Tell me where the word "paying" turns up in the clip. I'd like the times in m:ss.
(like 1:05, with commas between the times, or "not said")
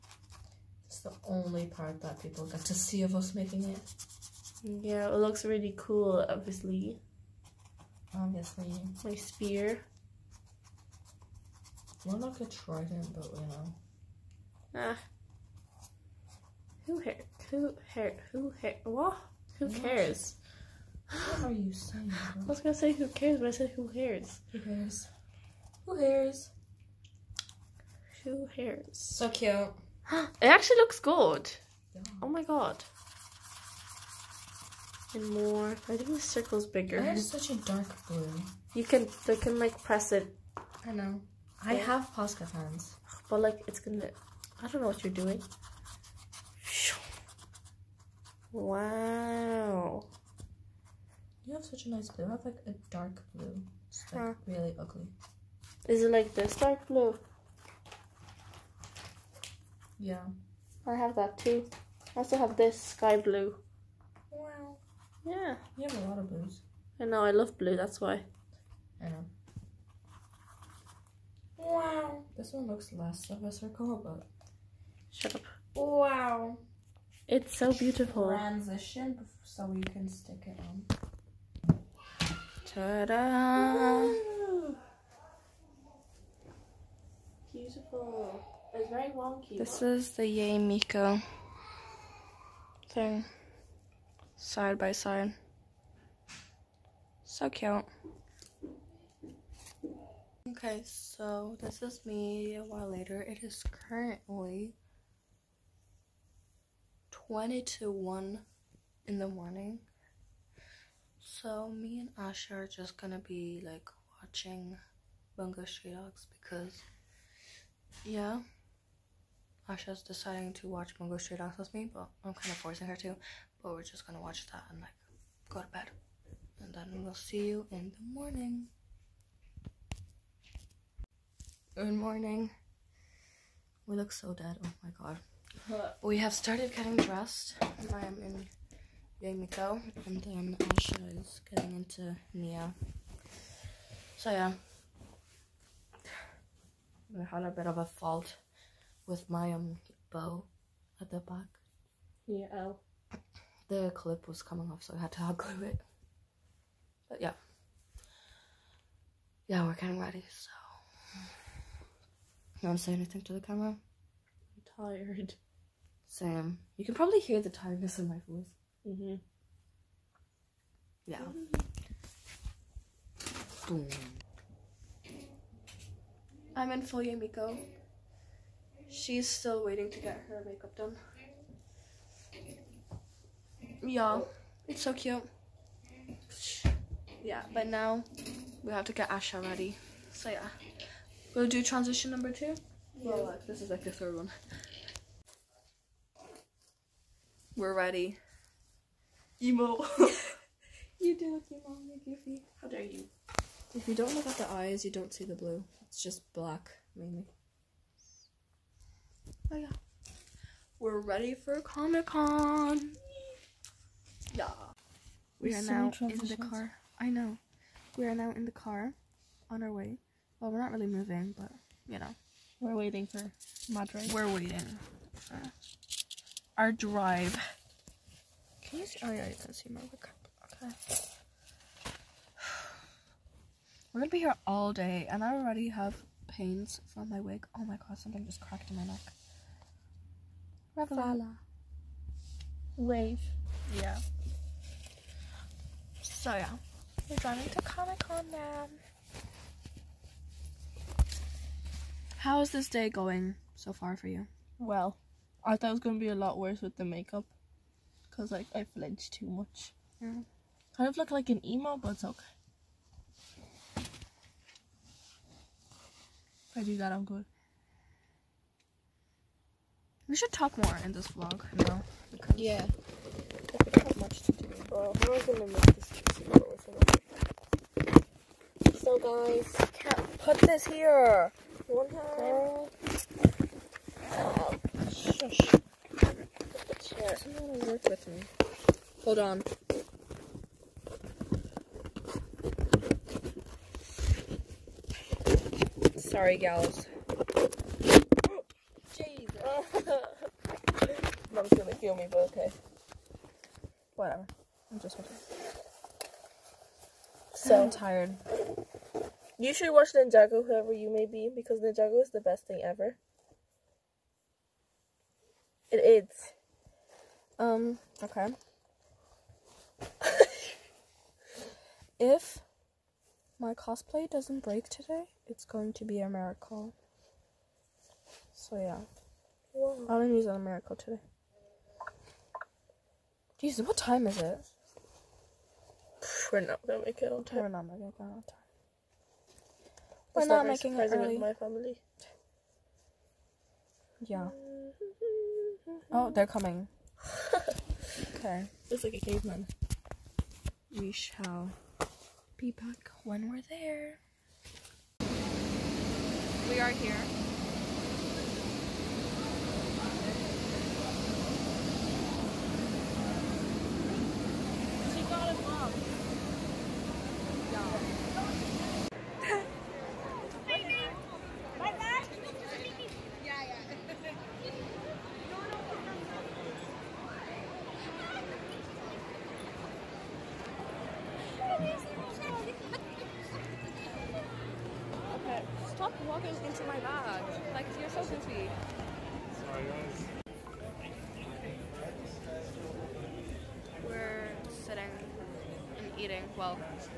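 not said.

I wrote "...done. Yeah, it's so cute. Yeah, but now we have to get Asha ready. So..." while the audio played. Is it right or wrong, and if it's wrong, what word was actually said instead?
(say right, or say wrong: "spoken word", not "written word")
right.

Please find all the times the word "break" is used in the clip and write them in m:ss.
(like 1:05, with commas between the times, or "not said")
5:24.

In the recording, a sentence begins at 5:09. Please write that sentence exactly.
You should watch Ninjago, whoever you may be, because Ninjago is the best thing ever.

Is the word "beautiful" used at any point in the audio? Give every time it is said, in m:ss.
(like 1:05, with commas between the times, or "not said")
1:17, 1:27.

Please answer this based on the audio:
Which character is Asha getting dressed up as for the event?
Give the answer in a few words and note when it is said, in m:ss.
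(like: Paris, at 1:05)
Nya, at 2:20.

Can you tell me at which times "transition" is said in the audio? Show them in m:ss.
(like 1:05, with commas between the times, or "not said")
1:18, 3:11.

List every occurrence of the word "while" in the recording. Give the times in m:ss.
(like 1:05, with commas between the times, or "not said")
1:42.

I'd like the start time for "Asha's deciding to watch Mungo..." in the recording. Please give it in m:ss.
1:59.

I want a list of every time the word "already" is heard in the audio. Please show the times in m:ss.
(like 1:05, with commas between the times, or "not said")
3:55.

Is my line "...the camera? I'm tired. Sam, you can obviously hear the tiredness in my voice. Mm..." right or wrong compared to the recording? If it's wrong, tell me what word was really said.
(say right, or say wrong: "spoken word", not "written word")
wrong: "probably", not "obviously".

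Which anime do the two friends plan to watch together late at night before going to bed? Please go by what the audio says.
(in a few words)
Bungo Stray Dogs.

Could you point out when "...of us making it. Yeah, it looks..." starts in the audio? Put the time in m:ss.
0:03.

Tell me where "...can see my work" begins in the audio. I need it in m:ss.
3:49.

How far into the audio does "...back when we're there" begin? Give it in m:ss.
5:52.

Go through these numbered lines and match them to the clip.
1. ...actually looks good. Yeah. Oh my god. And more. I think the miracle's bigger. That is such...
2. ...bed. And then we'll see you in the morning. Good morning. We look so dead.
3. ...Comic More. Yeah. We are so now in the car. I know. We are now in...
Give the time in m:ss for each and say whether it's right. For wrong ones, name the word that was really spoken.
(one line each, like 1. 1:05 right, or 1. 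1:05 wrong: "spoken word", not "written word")
1. 0:30 wrong: "circle", not "miracle"
2. 2:05 right
3. 3:31 wrong: "Con", not "More".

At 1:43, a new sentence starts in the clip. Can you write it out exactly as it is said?
It is currently 20 to 1 in the morning.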